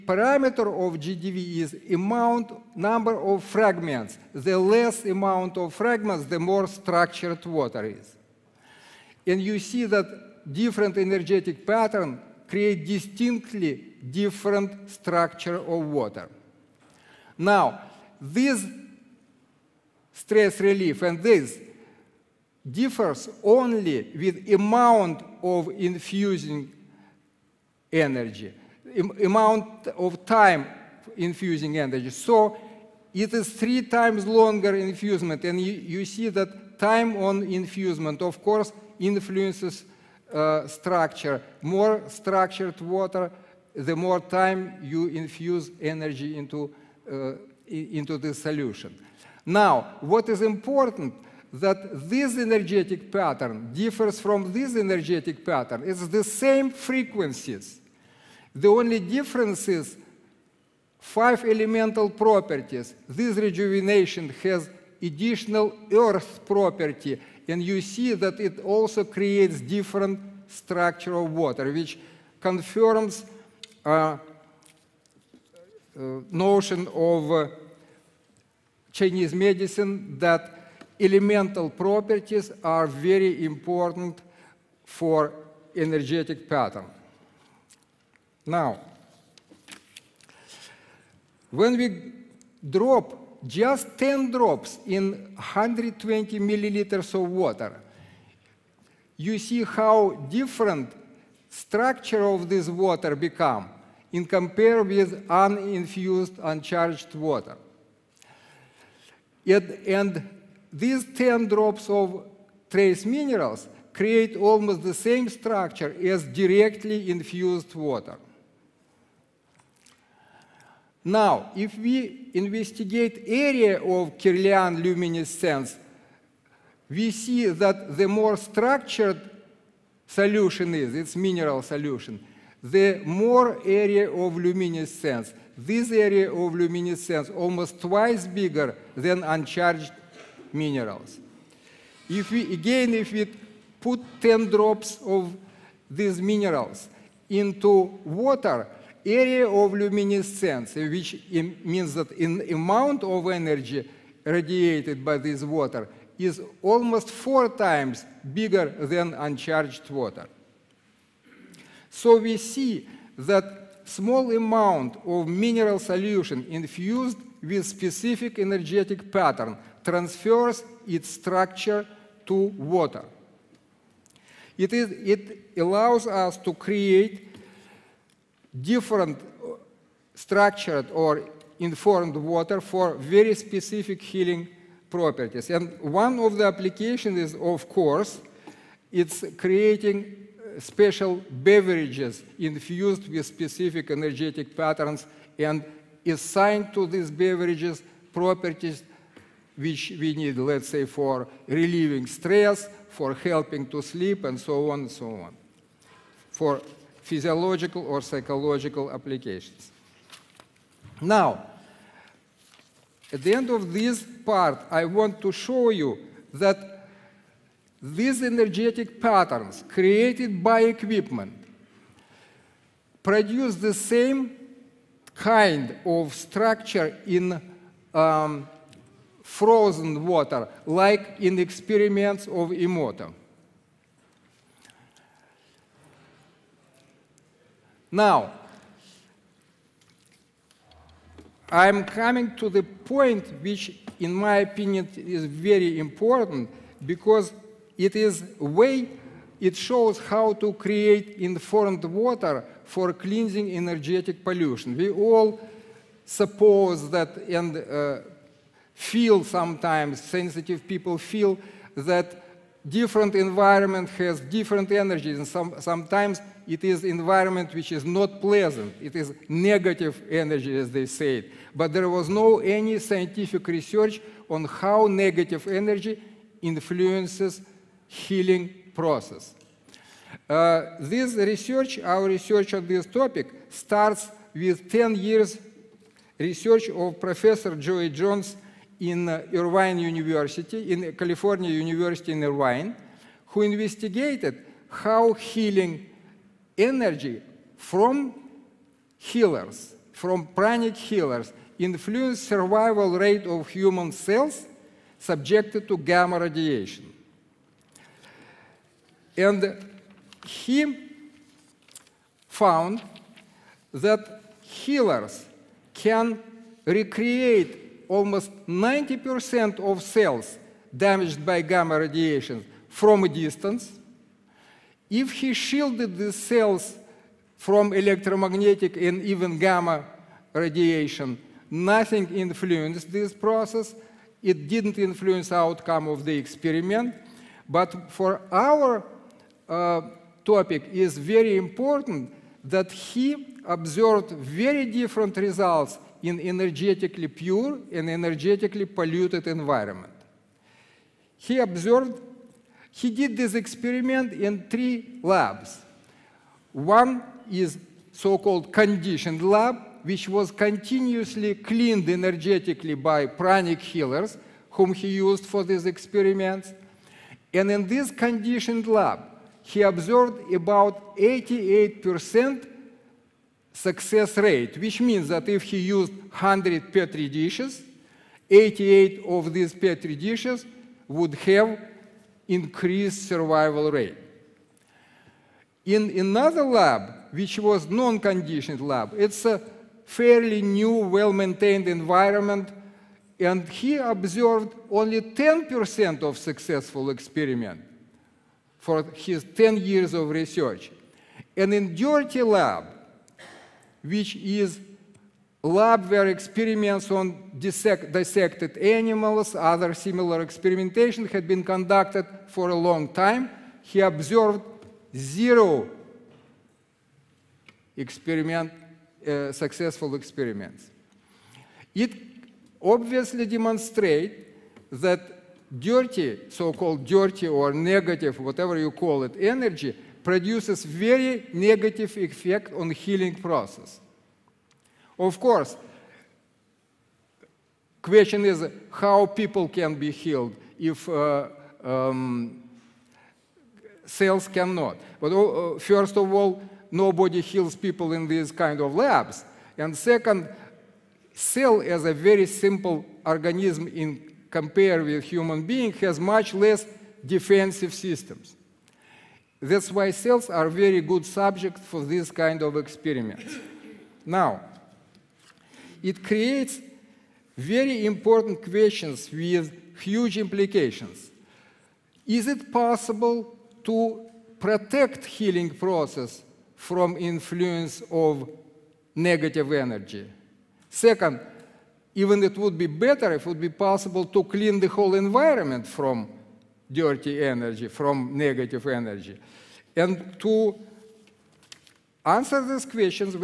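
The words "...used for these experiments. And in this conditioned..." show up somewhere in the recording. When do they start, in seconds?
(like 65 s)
364 s.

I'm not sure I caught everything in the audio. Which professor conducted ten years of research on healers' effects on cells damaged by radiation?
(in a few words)
Joie Jones.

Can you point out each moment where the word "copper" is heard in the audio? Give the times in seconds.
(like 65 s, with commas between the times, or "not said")
not said.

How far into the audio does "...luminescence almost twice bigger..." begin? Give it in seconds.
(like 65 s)
136 s.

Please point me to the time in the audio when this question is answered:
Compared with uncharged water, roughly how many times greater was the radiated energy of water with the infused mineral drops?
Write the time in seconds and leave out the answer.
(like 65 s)
157 s.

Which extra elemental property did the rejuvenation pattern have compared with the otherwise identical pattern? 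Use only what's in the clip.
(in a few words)
Earth.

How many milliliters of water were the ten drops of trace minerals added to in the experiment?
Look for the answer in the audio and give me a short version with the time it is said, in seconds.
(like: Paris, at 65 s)
120, at 95 s.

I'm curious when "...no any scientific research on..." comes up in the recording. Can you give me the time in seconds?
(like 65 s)
272 s.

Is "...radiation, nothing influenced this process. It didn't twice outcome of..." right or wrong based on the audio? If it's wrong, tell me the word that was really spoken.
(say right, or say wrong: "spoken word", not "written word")
wrong: "influence", not "twice".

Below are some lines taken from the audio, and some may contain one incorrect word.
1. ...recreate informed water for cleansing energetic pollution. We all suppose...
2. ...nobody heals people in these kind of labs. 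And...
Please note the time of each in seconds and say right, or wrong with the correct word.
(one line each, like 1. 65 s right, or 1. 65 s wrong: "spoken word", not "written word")
1. 250 s wrong: "create", not "recreate"
2. 446 s right.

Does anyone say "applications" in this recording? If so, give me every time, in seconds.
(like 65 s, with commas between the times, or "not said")
186 s, 208 s.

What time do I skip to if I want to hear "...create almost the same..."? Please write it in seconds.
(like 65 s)
113 s.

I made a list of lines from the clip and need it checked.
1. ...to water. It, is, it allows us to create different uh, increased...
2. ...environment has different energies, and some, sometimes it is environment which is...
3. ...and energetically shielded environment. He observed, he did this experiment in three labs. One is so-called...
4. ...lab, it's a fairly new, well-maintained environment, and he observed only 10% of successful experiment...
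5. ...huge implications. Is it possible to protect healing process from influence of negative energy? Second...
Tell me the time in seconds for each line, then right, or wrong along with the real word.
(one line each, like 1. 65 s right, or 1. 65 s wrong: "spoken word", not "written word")
1. 172 s wrong: "structured", not "increased"
2. 263 s right
3. 347 s wrong: "polluted", not "shielded"
4. 388 s right
5. 469 s right.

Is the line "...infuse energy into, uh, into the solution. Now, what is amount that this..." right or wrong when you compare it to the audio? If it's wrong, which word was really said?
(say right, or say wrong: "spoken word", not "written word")
wrong: "important", not "amount".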